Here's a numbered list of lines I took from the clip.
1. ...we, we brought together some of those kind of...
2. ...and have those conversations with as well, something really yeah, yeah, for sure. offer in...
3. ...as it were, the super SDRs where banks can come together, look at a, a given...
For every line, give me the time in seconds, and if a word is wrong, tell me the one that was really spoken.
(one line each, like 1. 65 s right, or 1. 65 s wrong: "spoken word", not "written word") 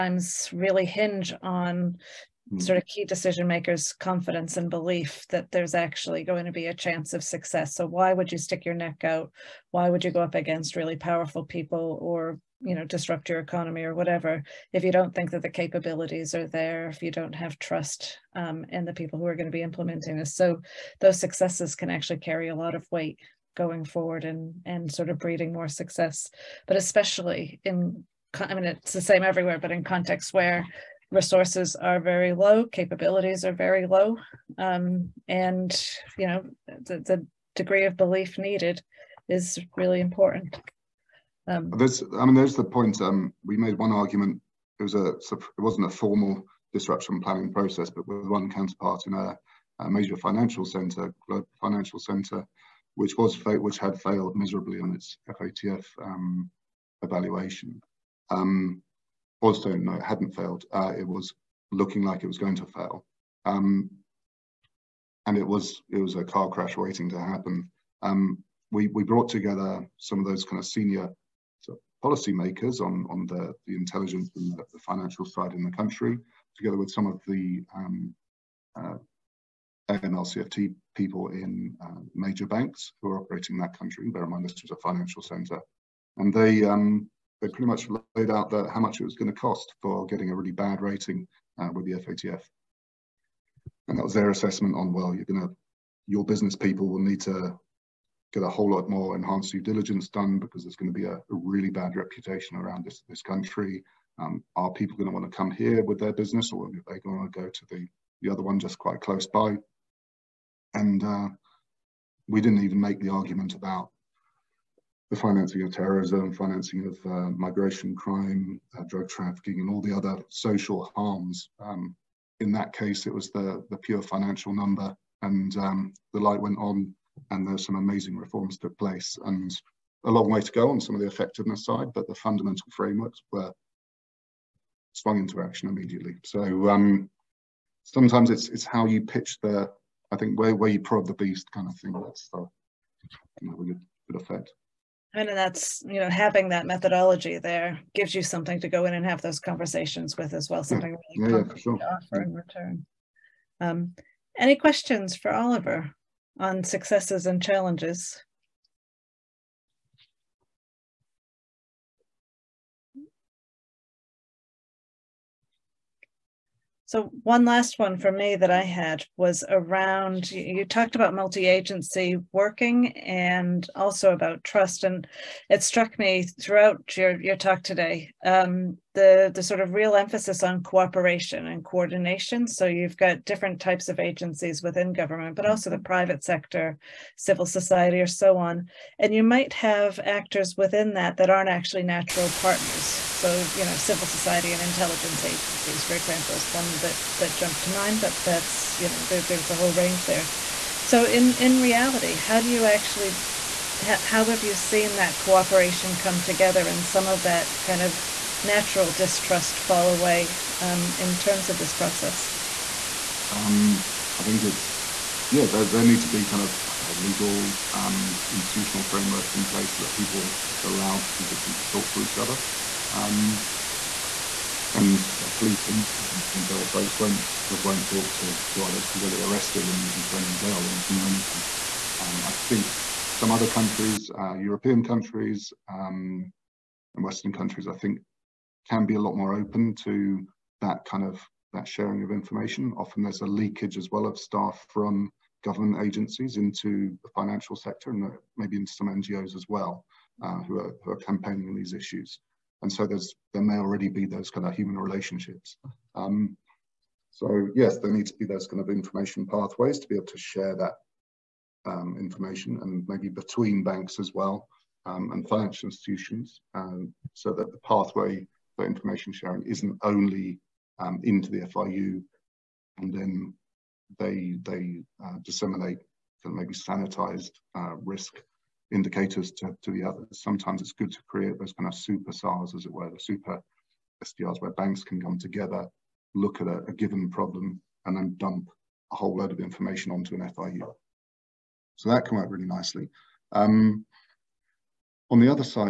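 1. 68 s right
2. 148 s right
3. 282 s right.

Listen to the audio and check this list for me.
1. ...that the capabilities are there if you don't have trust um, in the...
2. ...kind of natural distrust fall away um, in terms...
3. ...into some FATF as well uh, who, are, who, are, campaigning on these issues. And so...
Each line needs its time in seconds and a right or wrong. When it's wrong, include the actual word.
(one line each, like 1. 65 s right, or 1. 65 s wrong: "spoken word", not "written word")
1. 15 s right
2. 207 s right
3. 248 s wrong: "NGOs", not "FATF".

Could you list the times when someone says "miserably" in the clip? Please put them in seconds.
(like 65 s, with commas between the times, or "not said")
54 s.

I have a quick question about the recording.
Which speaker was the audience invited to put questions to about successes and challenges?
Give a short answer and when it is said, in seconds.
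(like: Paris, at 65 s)
Oliver, at 155 s.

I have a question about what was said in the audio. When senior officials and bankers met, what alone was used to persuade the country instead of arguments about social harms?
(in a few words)
the pure financial number.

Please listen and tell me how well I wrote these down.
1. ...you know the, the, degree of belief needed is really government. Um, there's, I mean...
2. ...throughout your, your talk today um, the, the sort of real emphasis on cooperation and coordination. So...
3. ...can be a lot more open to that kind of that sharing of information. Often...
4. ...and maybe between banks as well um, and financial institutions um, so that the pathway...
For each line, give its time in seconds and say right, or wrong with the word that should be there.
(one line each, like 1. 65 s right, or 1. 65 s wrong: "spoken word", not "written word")
1. 36 s wrong: "important", not "government"
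2. 176 s right
3. 238 s right
4. 262 s right.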